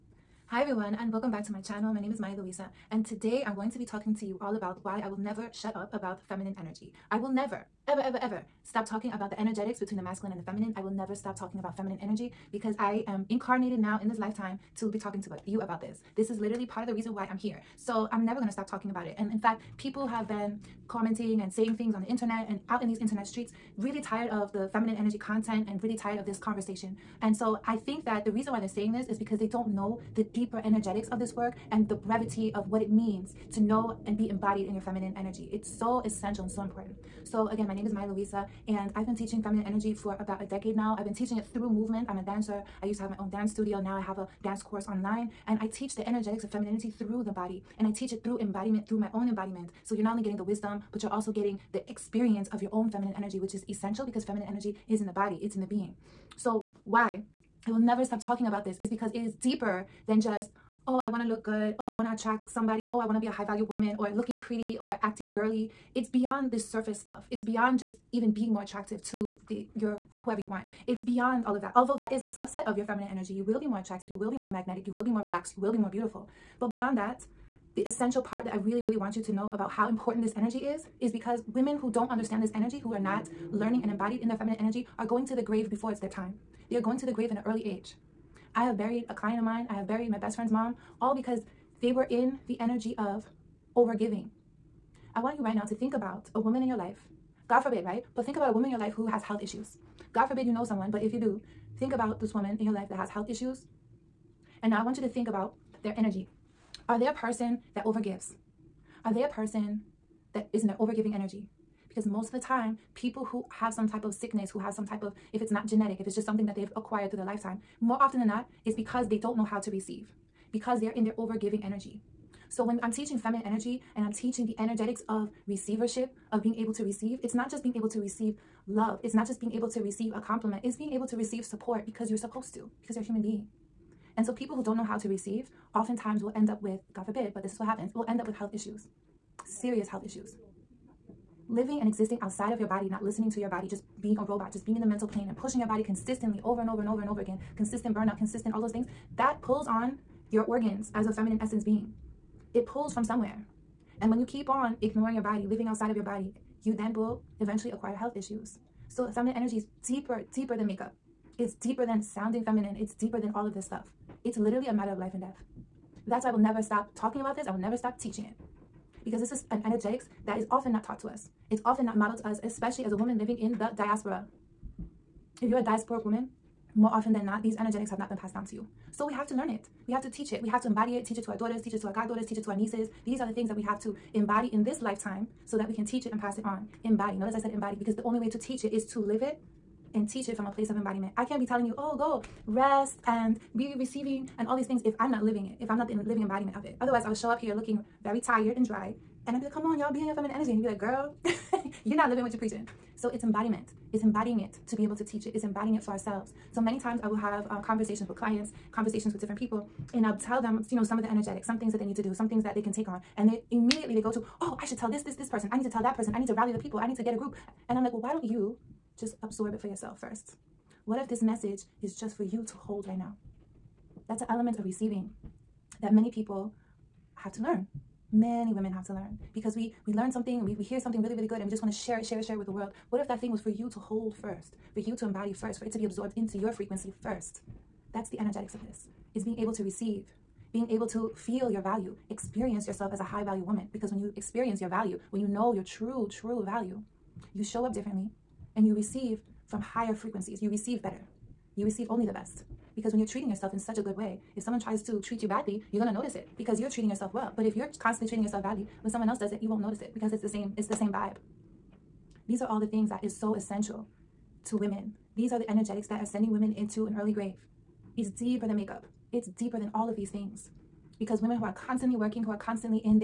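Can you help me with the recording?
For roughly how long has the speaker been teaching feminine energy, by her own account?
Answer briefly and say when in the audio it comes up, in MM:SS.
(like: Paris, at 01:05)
about a decade, at 00:40.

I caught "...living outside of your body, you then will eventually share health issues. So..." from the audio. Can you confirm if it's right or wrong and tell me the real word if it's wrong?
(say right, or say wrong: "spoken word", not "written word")
wrong: "acquire", not "share".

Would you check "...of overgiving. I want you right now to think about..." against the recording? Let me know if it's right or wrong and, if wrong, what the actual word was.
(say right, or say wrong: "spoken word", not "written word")
right.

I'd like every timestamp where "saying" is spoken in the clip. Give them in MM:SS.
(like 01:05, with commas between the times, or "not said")
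00:21, 00:28.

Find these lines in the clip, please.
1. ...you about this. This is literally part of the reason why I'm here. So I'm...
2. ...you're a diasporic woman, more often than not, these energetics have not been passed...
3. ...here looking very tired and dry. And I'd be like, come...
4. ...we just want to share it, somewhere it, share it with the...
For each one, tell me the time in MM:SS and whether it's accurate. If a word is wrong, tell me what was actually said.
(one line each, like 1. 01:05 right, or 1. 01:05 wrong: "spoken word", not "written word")
1. 00:15 right
2. 02:55 right
3. 03:17 right
4. 03:51 wrong: "share", not "somewhere".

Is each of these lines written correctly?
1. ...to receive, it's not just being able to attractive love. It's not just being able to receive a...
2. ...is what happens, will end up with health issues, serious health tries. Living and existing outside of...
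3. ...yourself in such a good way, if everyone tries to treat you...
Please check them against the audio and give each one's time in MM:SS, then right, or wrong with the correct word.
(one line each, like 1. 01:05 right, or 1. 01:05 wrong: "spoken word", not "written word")
1. 02:06 wrong: "receive", not "attractive"
2. 02:17 wrong: "issues", not "tries"
3. 04:13 wrong: "someone", not "everyone".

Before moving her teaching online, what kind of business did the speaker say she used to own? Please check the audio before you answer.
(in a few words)
dance studio.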